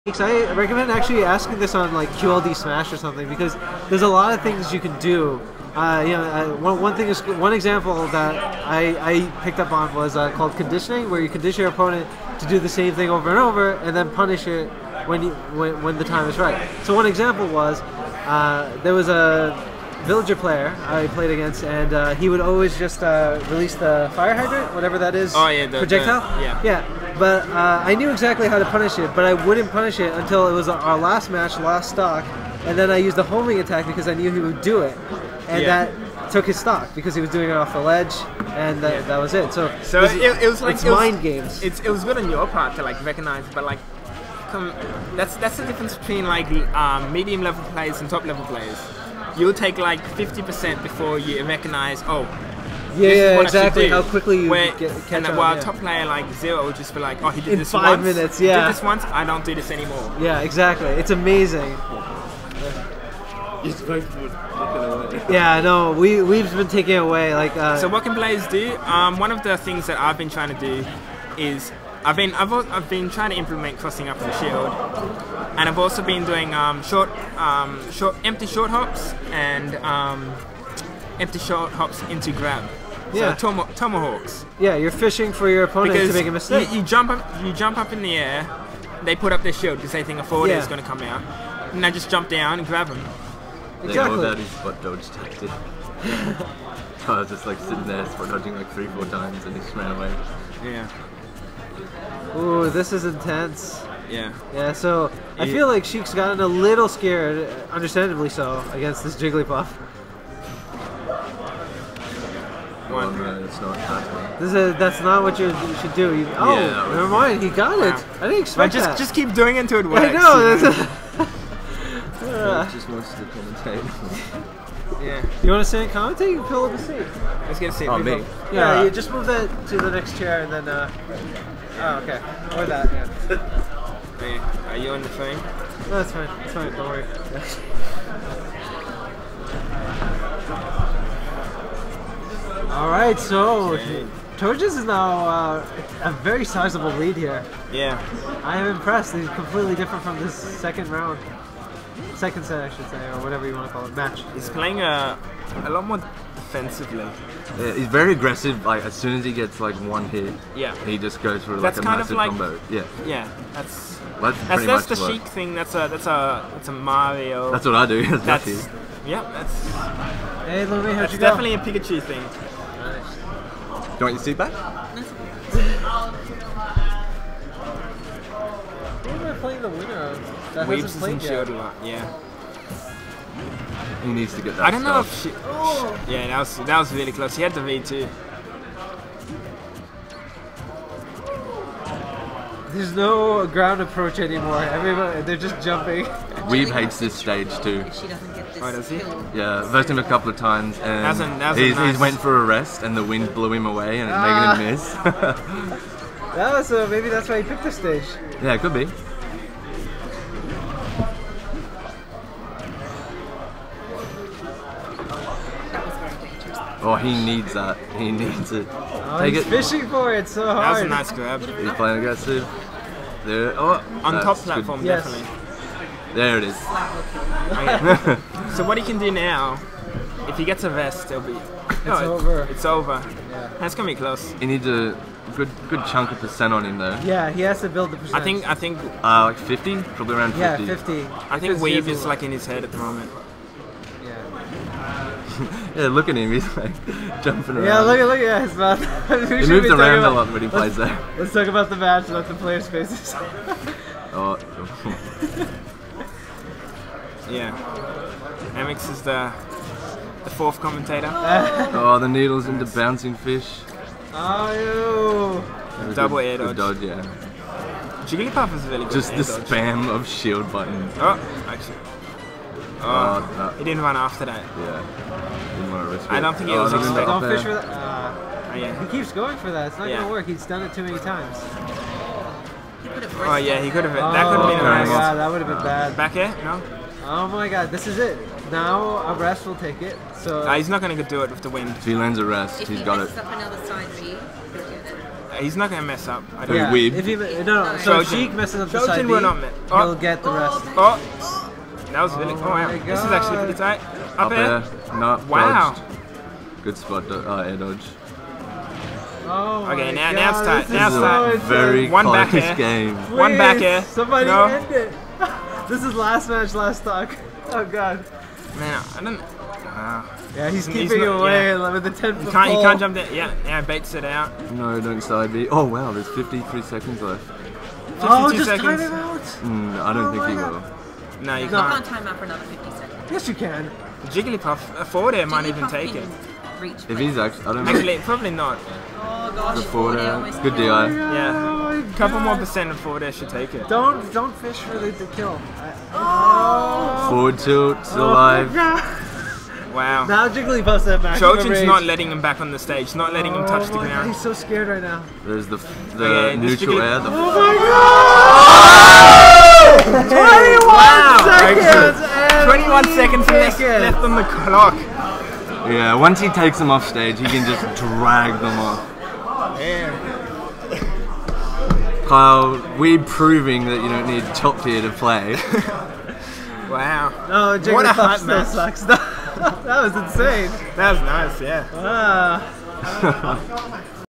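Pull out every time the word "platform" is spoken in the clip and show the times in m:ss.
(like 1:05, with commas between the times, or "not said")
3:44.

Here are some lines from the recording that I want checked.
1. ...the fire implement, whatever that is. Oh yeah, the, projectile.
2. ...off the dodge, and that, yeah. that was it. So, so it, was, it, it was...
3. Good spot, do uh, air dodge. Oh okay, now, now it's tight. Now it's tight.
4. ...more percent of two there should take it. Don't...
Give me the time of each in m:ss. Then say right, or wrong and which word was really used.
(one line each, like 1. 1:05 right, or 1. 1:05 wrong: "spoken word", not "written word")
1. 0:23 wrong: "hydrant", not "implement"
2. 0:37 wrong: "ledge", not "dodge"
3. 5:06 right
4. 5:42 wrong: "four", not "two".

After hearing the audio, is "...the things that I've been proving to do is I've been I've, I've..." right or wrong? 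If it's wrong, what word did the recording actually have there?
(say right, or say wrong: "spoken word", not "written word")
wrong: "trying", not "proving".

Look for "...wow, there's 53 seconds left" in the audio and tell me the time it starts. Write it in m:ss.
5:25.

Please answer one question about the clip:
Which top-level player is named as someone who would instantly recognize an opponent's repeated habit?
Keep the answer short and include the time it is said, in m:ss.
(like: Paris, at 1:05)
Zero, at 0:56.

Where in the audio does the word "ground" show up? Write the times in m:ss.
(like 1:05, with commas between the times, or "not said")
3:13, 5:53.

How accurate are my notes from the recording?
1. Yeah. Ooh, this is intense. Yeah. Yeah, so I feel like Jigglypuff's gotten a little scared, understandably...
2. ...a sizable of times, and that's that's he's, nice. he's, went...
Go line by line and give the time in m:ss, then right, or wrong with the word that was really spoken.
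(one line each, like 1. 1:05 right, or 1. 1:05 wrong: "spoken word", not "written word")
1. 1:40 wrong: "Sheik", not "Jigglypuff"
2. 3:19 wrong: "couple", not "sizable".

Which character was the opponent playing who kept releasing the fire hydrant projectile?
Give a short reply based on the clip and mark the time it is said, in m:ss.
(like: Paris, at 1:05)
Villager, at 0:20.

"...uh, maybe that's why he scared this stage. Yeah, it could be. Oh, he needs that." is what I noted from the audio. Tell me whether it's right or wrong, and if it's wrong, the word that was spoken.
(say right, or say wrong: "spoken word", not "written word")
wrong: "picked", not "scared".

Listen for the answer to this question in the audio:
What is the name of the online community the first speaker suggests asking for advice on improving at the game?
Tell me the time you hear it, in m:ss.
0:02.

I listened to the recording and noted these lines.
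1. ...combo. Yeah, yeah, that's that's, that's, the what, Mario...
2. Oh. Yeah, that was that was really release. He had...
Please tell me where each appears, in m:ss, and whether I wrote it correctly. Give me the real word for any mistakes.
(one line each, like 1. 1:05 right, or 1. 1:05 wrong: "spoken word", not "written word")
1. 2:42 wrong: "Sheik", not "Mario"
2. 3:05 wrong: "close", not "release".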